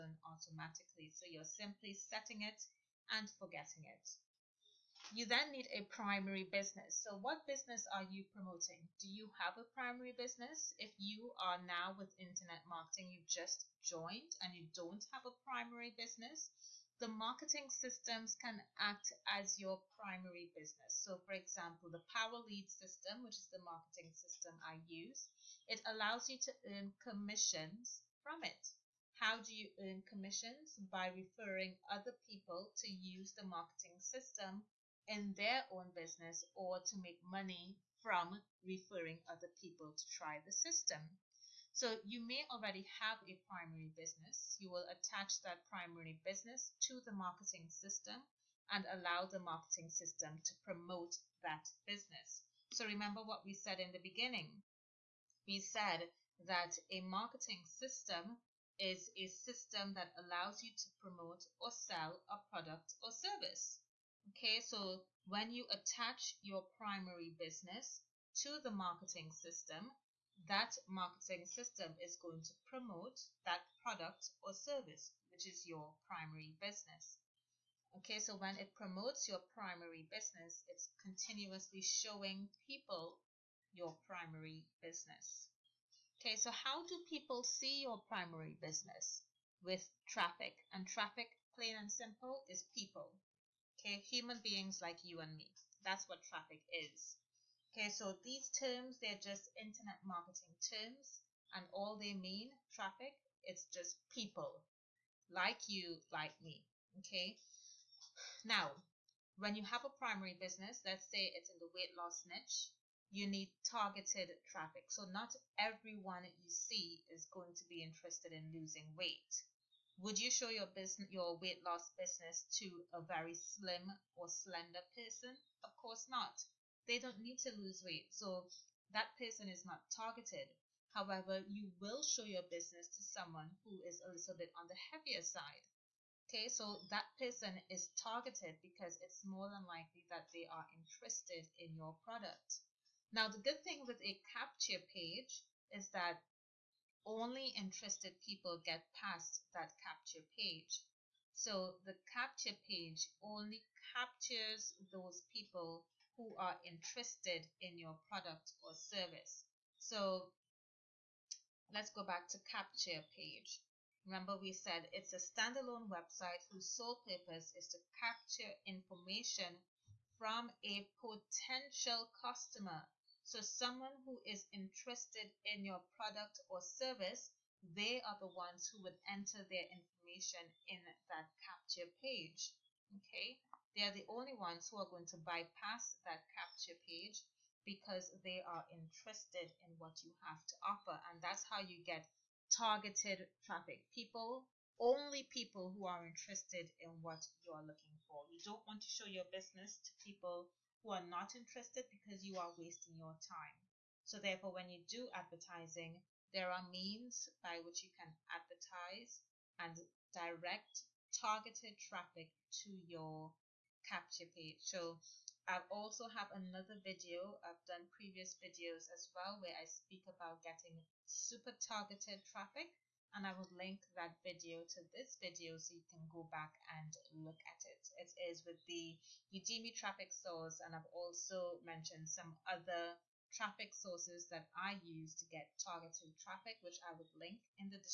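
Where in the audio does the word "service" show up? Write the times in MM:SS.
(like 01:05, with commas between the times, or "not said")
01:03, 01:14, 02:38, 02:56.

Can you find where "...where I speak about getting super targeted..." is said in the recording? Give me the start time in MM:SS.
03:39.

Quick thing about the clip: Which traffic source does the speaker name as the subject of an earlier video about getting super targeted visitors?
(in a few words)
Udimi.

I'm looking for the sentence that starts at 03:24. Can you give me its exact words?
So therefore, when you do advertising, there are means by which you can advertise and direct targeted traffic to your capture page.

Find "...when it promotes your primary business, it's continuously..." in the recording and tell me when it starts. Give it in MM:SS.
01:18.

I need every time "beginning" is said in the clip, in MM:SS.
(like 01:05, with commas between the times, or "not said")
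00:53.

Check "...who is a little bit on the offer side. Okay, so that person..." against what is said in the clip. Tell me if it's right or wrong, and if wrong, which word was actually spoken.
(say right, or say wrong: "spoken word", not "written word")
wrong: "heavier", not "offer".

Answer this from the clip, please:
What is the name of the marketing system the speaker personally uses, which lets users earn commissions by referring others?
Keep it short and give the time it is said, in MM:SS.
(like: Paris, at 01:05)
Power Lead system, at 00:22.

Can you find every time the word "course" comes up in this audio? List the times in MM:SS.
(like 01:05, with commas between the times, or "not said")
02:05.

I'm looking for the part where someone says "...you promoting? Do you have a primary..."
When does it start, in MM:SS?
00:08.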